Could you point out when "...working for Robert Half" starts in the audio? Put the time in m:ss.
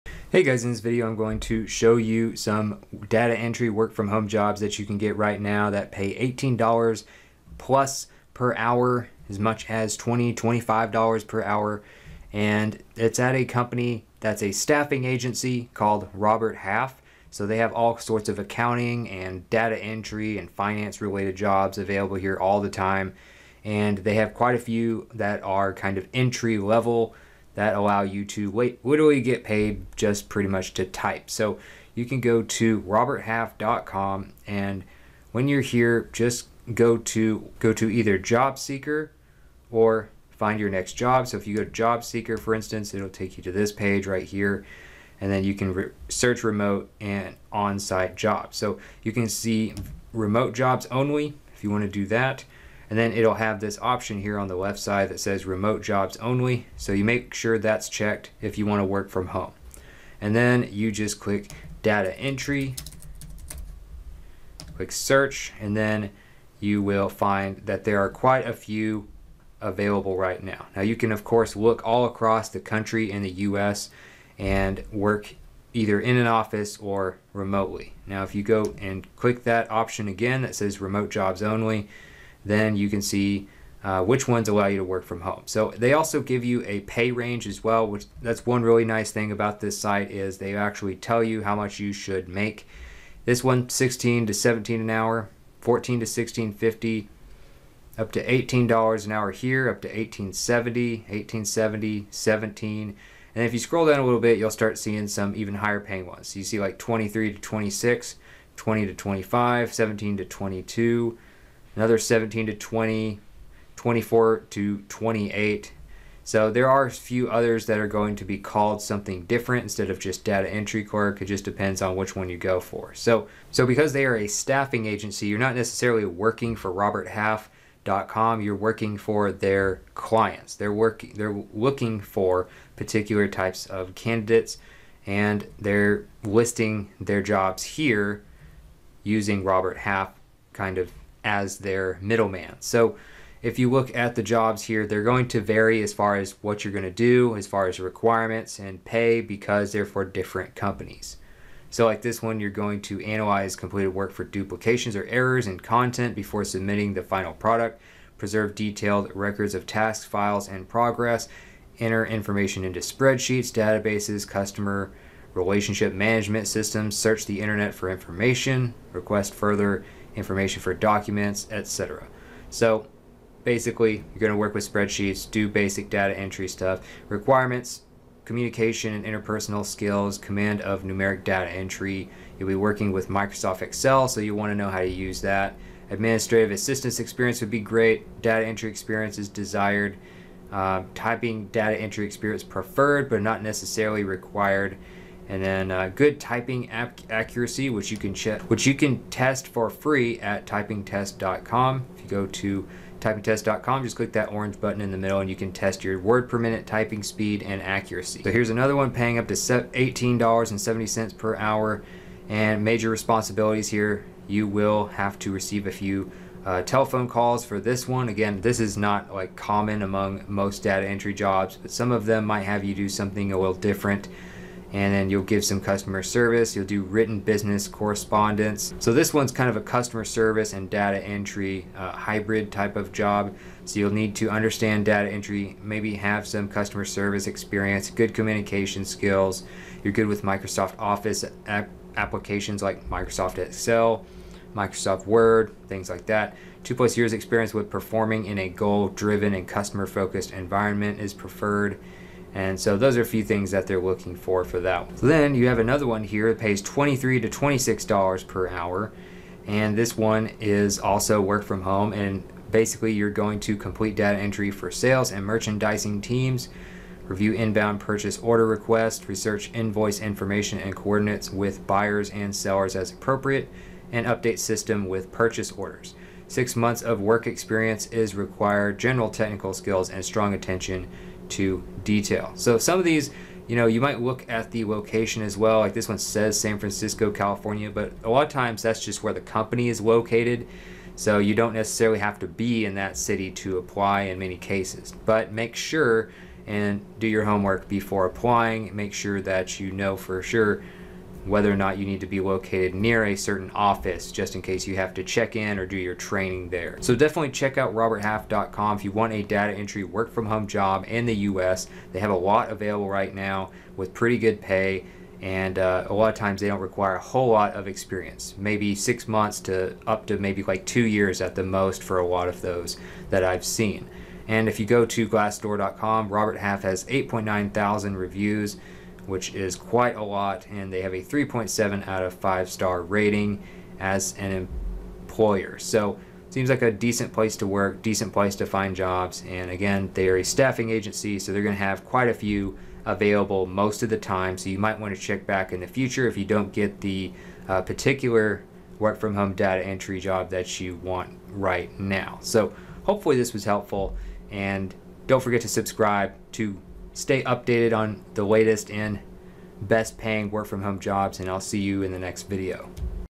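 2:06.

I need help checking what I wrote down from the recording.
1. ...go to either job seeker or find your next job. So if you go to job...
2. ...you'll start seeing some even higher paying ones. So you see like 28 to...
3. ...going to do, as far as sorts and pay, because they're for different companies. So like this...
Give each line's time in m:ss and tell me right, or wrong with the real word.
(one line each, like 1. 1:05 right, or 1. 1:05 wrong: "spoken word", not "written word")
1. 0:37 right
2. 1:44 wrong: "23", not "28"
3. 2:26 wrong: "requirements", not "sorts".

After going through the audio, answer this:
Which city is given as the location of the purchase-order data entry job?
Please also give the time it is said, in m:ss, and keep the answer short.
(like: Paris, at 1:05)
San Francisco, at 4:46.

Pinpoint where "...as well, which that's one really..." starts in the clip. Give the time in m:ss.
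1:27.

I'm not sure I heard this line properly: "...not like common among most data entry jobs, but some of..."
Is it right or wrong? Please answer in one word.
right.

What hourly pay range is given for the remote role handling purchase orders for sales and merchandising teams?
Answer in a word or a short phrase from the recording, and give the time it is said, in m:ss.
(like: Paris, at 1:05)
$23 to $26, at 4:16.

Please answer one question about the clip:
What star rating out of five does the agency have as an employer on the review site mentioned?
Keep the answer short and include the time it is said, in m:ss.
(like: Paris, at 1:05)
3.7, at 5:31.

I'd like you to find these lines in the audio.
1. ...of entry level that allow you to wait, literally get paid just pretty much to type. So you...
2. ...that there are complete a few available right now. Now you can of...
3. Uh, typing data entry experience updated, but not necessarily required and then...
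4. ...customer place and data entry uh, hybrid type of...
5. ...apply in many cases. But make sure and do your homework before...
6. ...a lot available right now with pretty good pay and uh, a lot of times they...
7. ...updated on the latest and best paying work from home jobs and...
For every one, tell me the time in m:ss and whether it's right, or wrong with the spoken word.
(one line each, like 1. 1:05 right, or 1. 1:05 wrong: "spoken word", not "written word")
1. 0:25 right
2. 1:07 wrong: "quite", not "complete"
3. 3:10 wrong: "preferred", not "updated"
4. 3:49 wrong: "service", not "place"
5. 4:53 right
6. 5:12 right
7. 5:57 right.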